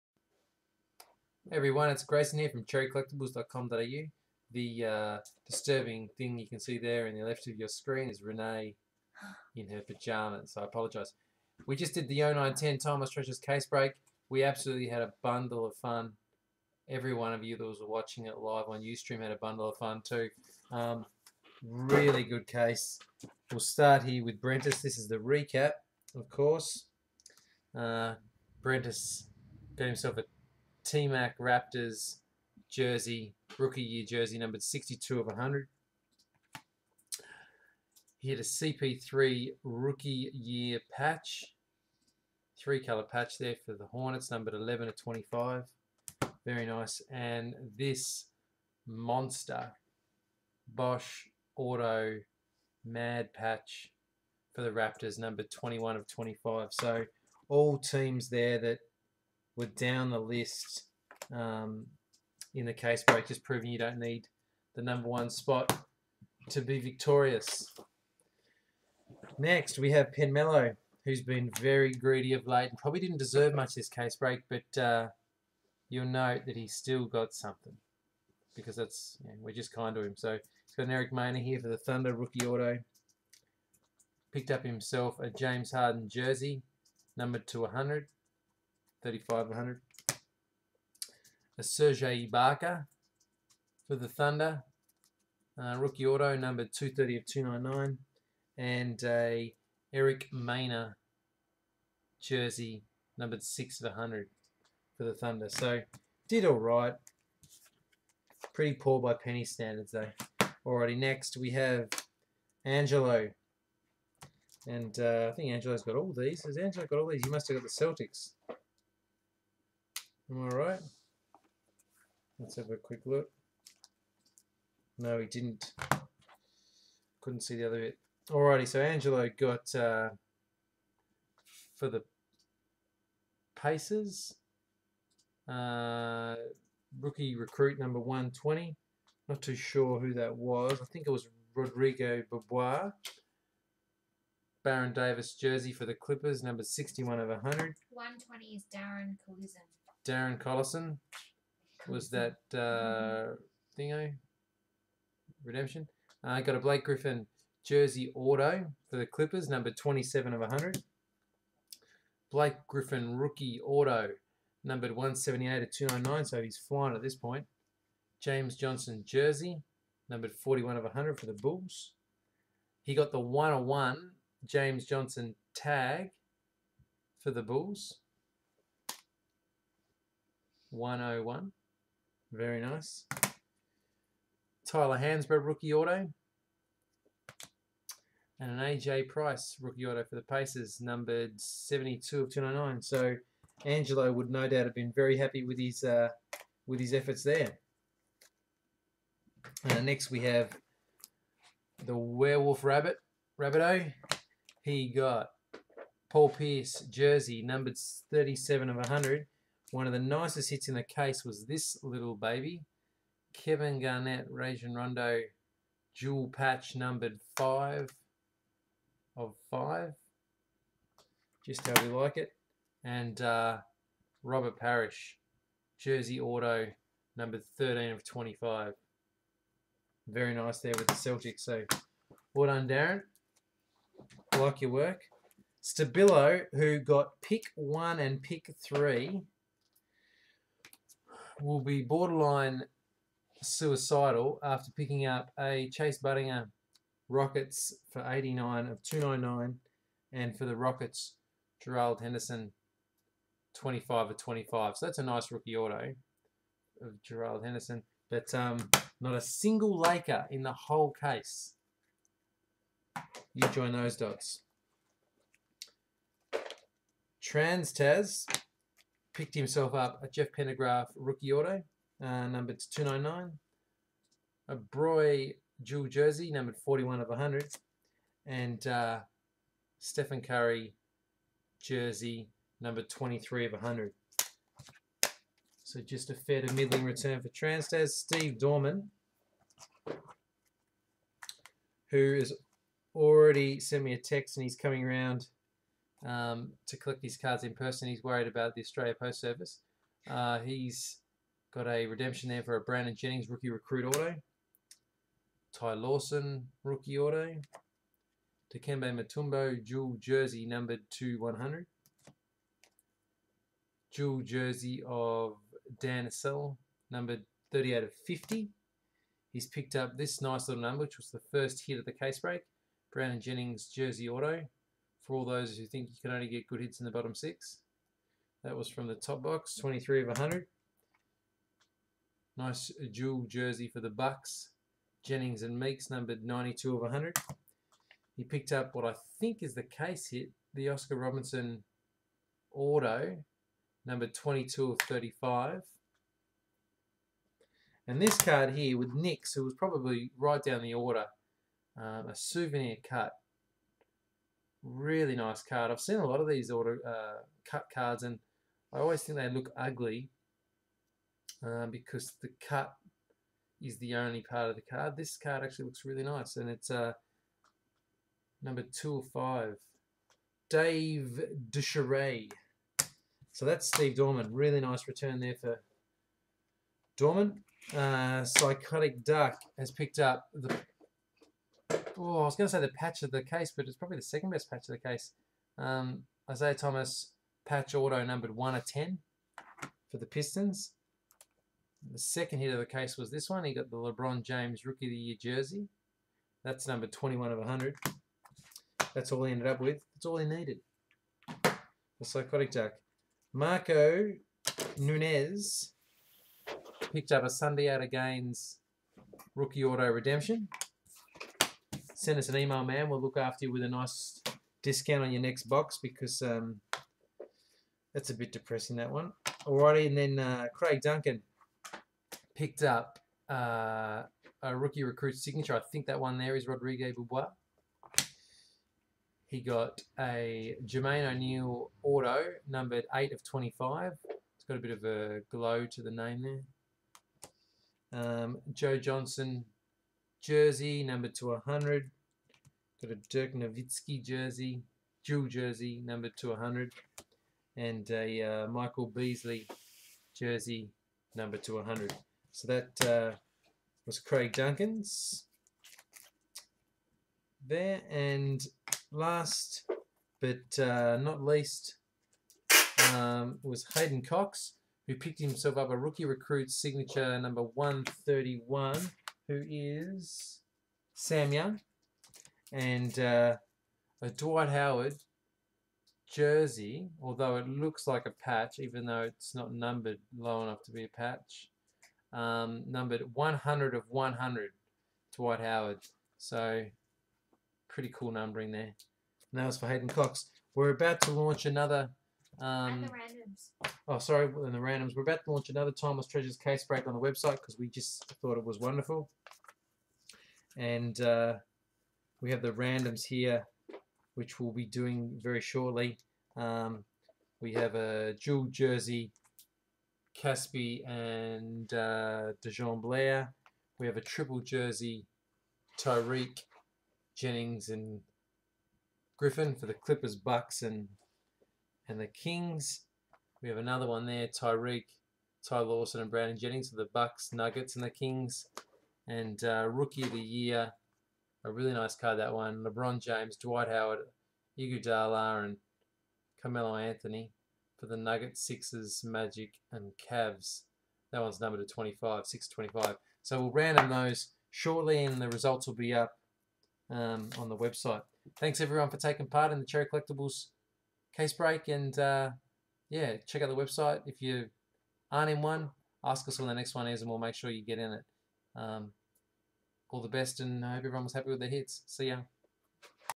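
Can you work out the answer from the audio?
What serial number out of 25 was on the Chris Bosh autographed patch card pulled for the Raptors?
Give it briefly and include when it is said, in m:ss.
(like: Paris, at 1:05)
21, at 0:55.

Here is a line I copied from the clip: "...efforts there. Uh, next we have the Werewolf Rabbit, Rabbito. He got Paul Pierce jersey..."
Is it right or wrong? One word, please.
right.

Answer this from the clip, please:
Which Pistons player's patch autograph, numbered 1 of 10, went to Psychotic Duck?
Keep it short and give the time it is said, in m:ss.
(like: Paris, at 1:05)
Isiah Thomas, at 6:26.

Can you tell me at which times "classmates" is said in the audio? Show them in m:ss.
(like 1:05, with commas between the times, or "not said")
not said.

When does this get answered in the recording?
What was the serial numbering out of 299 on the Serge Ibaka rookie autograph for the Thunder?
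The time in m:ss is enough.
1:36.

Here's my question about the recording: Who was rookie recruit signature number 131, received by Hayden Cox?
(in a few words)
Sam Young.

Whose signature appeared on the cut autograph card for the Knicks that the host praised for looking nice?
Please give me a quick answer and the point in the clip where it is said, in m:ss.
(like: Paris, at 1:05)
Dave DeBusschere, at 6:10.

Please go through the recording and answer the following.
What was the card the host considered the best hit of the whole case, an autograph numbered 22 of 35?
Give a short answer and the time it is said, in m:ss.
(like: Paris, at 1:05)
Oscar Robertson Auto, at 5:40.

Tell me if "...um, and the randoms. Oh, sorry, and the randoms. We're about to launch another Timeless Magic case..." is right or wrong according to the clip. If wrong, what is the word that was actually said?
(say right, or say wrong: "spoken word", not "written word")
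wrong: "Treasures", not "Magic".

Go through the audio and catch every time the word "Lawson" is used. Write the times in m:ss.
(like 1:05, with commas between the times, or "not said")
5:05, 8:45.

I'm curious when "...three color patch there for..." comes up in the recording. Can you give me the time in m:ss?
0:42.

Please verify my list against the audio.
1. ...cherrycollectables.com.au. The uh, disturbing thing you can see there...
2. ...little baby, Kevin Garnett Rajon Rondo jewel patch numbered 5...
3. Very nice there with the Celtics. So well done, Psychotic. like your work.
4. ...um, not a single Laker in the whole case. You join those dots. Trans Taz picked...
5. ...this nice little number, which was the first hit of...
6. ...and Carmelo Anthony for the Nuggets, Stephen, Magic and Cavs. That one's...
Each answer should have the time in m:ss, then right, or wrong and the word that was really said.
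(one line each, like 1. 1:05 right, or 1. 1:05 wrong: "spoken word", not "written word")
1. 0:02 right
2. 3:31 right
3. 3:50 wrong: "Darren", not "Psychotic"
4. 4:18 right
5. 5:19 right
6. 8:55 wrong: "Sixers", not "Stephen".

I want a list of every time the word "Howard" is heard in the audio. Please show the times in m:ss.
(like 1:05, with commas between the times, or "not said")
7:54, 8:05, 8:53.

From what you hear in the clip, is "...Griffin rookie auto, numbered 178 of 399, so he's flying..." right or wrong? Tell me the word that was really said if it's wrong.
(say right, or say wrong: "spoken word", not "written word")
wrong: "299", not "399".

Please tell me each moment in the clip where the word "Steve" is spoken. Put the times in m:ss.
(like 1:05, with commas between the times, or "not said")
4:47, 6:13.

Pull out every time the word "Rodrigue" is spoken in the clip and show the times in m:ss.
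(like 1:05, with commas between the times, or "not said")
2:21, 7:06.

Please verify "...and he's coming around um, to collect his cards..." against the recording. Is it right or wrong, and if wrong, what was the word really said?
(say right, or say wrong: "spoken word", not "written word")
right.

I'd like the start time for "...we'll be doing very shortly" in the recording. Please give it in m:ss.
8:24.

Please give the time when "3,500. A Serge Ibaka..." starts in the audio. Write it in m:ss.
1:29.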